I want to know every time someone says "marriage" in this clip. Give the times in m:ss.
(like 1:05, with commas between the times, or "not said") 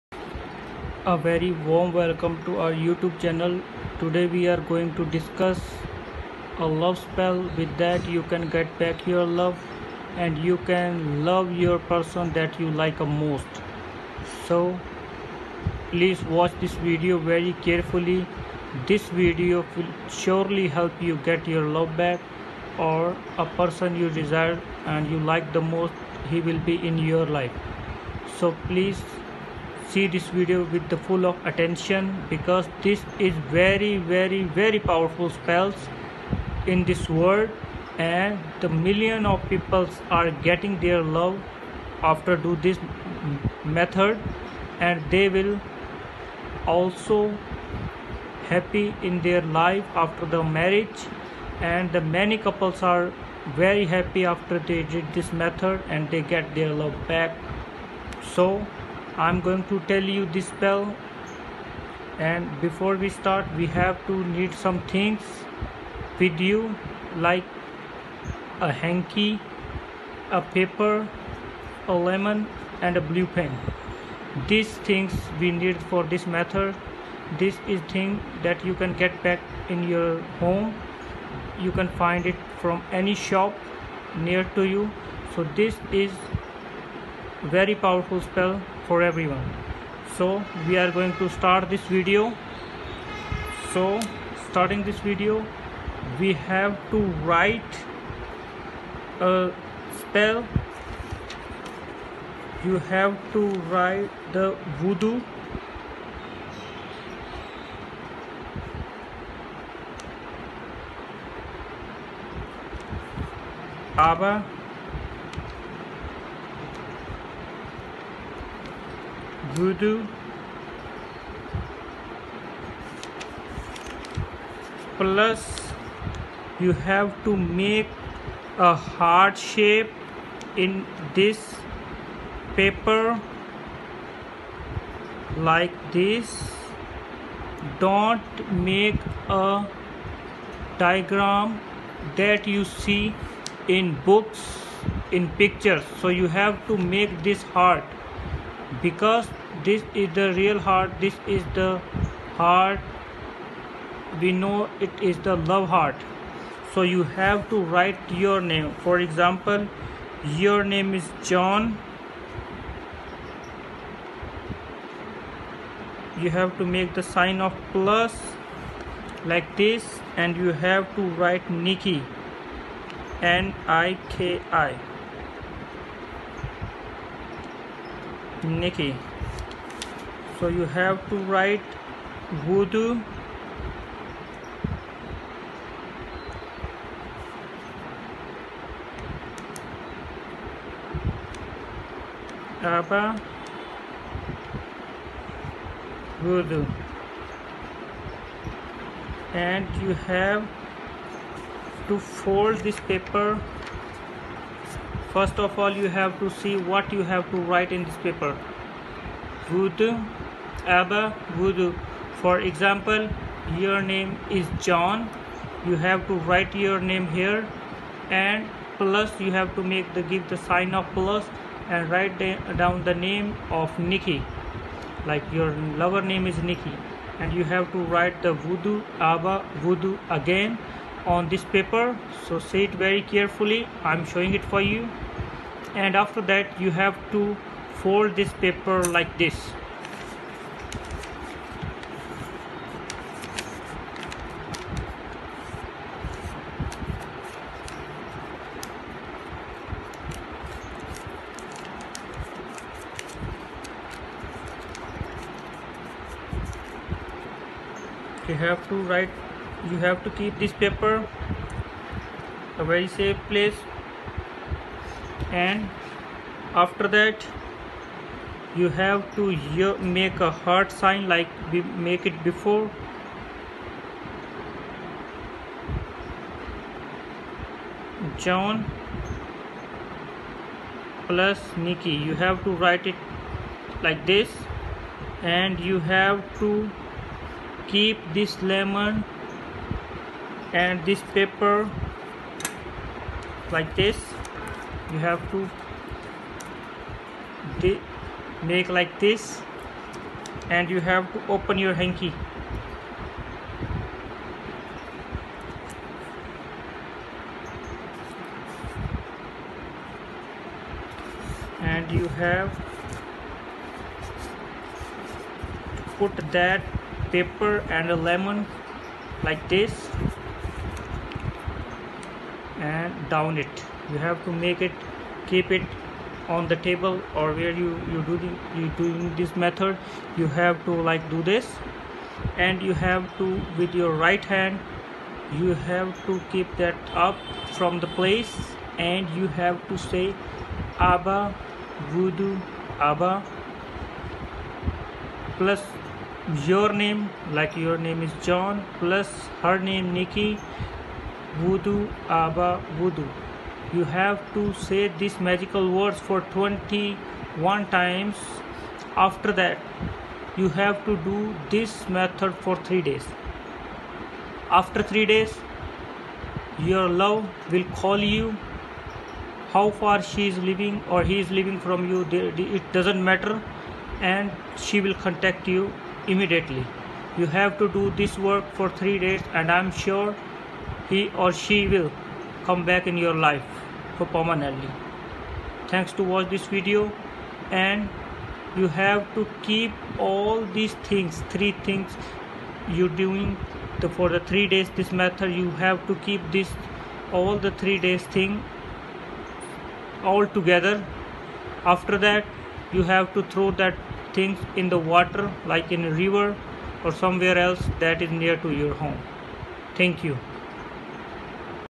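0:50.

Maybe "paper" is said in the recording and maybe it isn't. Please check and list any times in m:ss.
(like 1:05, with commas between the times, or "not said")
1:10, 2:12, 3:22, 3:28, 3:51, 3:58, 4:20.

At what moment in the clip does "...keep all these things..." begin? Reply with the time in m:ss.
6:29.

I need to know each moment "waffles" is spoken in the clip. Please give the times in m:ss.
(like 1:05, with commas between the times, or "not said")
not said.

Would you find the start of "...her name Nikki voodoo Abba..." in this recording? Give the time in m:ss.
5:49.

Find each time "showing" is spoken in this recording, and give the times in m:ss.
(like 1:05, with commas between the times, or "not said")
3:54.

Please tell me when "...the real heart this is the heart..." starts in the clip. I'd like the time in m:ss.
2:30.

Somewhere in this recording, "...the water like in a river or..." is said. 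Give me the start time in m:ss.
6:44.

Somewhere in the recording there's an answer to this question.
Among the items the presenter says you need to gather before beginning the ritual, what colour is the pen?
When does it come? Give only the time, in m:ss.
1:13.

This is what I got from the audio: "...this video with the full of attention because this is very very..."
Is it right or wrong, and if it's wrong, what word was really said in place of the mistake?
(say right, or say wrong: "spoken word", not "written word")
right.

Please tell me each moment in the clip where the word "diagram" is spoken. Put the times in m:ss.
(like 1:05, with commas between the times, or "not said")
2:20.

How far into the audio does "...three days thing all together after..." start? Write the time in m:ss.
6:37.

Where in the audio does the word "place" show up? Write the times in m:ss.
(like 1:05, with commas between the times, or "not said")
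4:23, 5:37.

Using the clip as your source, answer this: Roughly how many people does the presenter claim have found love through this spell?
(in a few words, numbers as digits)
million.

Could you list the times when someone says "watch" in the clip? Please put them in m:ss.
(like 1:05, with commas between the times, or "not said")
0:16, 6:26.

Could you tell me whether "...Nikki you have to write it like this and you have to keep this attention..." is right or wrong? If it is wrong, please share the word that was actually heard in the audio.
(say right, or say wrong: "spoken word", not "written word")
wrong: "lemon", not "attention".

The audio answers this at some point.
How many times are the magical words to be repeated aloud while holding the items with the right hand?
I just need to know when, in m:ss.
5:56.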